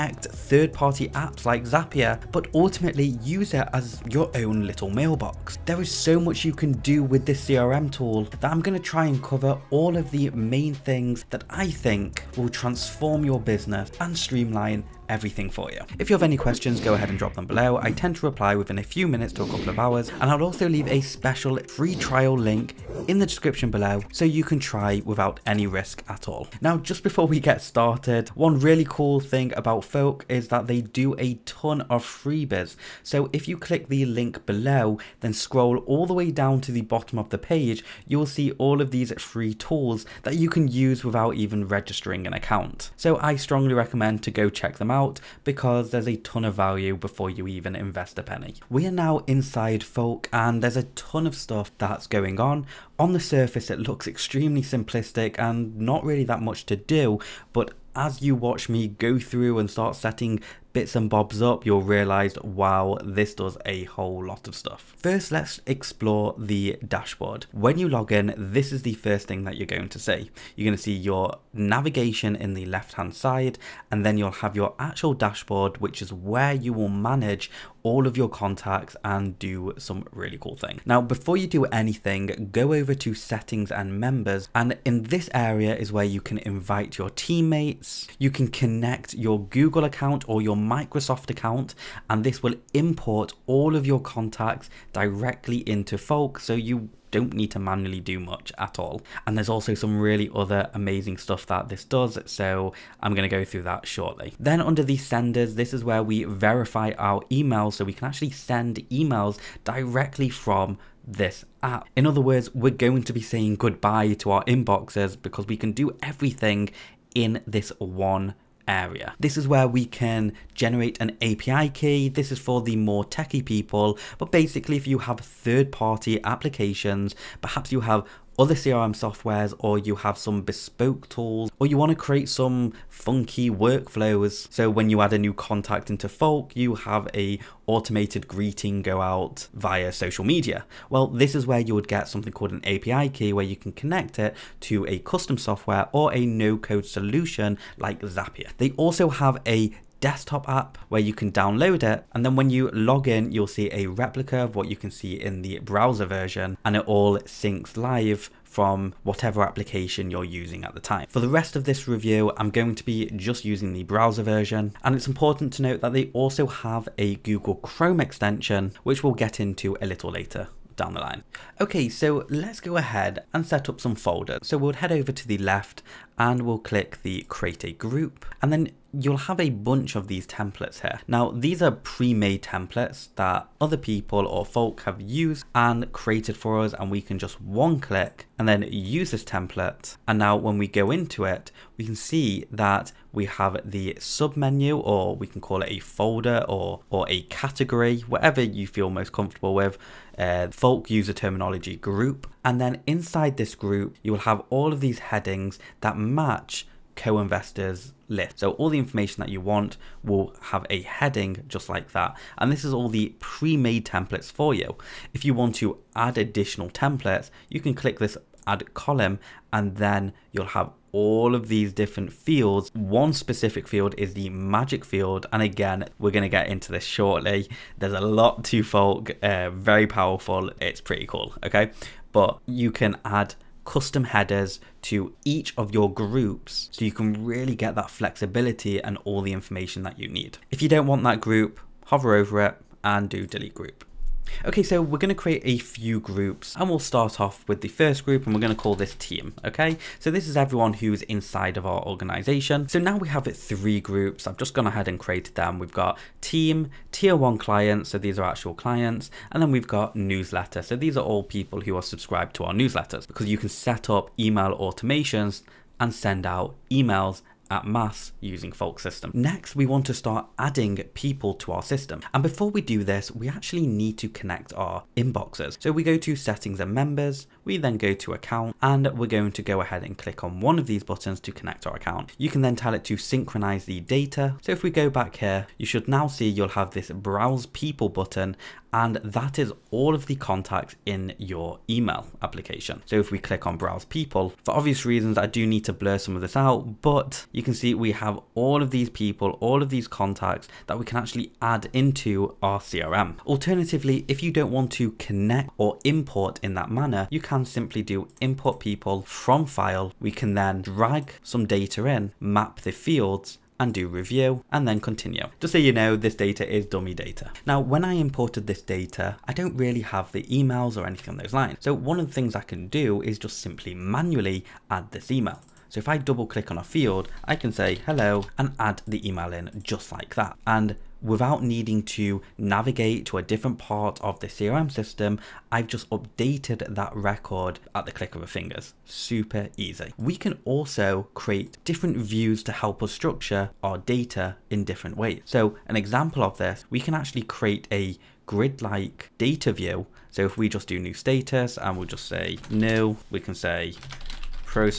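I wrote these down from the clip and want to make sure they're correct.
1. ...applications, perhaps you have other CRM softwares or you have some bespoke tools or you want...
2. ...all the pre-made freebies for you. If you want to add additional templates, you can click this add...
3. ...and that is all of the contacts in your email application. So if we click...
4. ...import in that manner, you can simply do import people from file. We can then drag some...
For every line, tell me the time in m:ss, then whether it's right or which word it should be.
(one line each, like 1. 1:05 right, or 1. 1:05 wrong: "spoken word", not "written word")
1. 2:06 right
2. 3:32 wrong: "templates", not "freebies"
3. 4:48 right
4. 5:05 right.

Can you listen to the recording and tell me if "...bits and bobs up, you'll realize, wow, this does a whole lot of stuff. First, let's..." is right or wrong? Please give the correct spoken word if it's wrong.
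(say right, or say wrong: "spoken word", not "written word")
right.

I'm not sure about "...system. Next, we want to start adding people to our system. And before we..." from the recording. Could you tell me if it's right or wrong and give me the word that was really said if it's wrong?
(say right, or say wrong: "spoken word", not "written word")
right.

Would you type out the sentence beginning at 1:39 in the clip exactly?
And there's also some really other amazing stuff that this does, so I'm going to go through that shortly.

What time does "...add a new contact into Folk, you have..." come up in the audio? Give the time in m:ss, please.
2:15.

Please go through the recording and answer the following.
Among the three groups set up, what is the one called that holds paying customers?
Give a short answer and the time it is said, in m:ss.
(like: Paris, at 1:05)
Tier one clients, at 4:16.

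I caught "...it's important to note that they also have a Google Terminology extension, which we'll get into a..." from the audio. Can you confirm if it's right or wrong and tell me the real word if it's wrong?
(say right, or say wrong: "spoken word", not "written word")
wrong: "Chrome", not "Terminology".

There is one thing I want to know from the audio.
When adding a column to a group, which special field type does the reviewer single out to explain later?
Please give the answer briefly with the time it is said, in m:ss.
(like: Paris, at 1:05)
Magic field, at 3:44.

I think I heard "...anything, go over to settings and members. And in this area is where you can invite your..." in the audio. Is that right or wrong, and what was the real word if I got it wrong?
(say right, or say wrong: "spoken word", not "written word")
right.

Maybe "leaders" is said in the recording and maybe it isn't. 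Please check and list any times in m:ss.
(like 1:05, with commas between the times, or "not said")
not said.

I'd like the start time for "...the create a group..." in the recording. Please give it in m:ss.
2:57.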